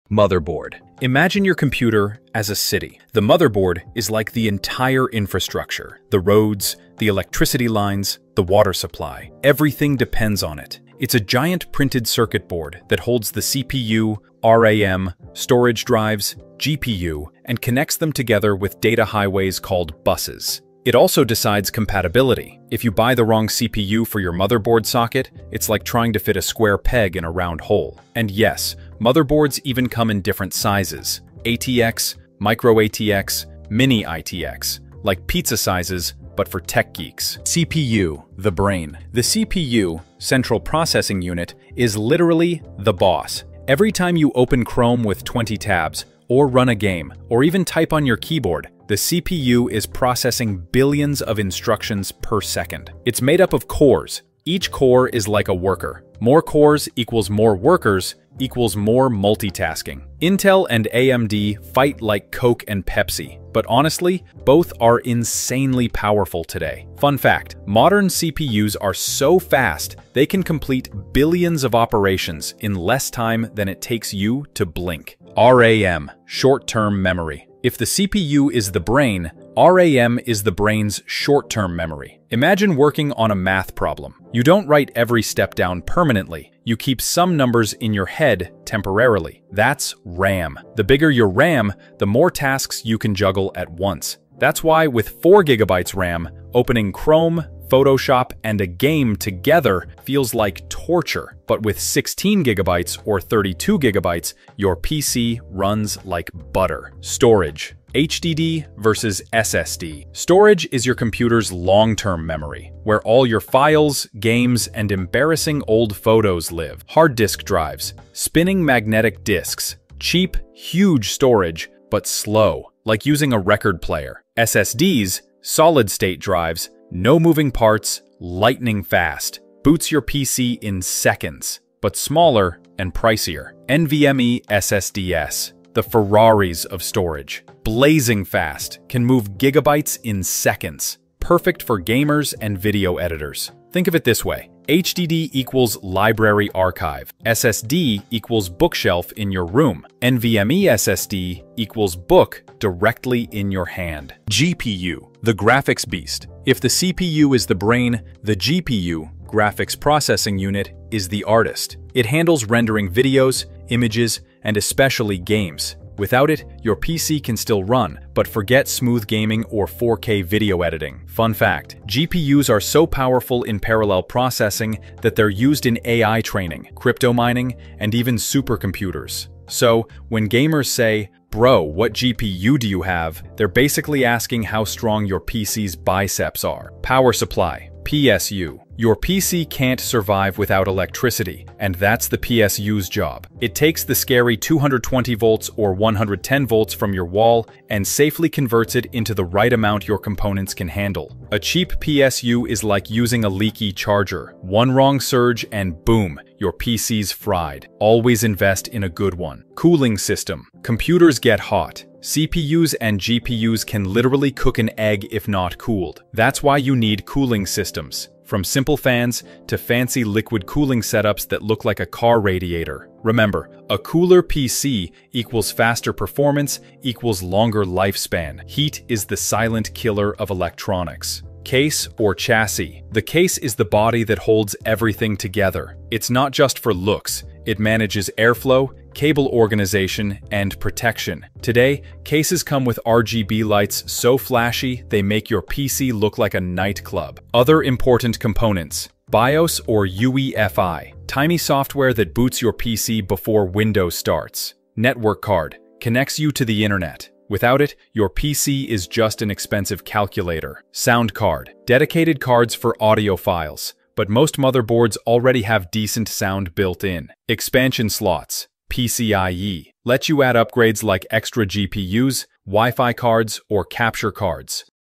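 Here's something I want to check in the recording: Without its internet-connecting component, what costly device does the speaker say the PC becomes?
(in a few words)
An expensive calculator.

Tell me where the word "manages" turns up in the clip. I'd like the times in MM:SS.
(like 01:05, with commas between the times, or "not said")
03:57.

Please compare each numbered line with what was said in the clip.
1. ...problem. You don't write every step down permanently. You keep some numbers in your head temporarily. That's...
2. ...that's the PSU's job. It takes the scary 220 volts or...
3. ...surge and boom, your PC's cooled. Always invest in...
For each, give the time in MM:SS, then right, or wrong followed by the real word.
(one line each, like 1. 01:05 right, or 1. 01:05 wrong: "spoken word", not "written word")
1. 01:23 right
2. 03:11 right
3. 03:24 wrong: "fried", not "cooled".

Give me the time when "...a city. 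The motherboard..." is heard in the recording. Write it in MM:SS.
00:02.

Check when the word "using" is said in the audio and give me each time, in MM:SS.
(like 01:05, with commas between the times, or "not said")
02:03, 03:22.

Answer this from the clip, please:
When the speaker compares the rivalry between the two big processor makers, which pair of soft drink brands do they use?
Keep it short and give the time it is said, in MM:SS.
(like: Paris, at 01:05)
Coke and Pepsi, at 01:02.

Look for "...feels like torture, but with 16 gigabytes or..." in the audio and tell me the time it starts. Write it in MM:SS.
01:40.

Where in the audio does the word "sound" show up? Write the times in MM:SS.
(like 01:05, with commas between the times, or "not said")
04:20, 04:26.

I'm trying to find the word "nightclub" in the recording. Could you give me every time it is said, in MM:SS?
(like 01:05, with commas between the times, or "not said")
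04:06.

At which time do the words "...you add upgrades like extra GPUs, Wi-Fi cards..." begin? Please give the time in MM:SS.
04:30.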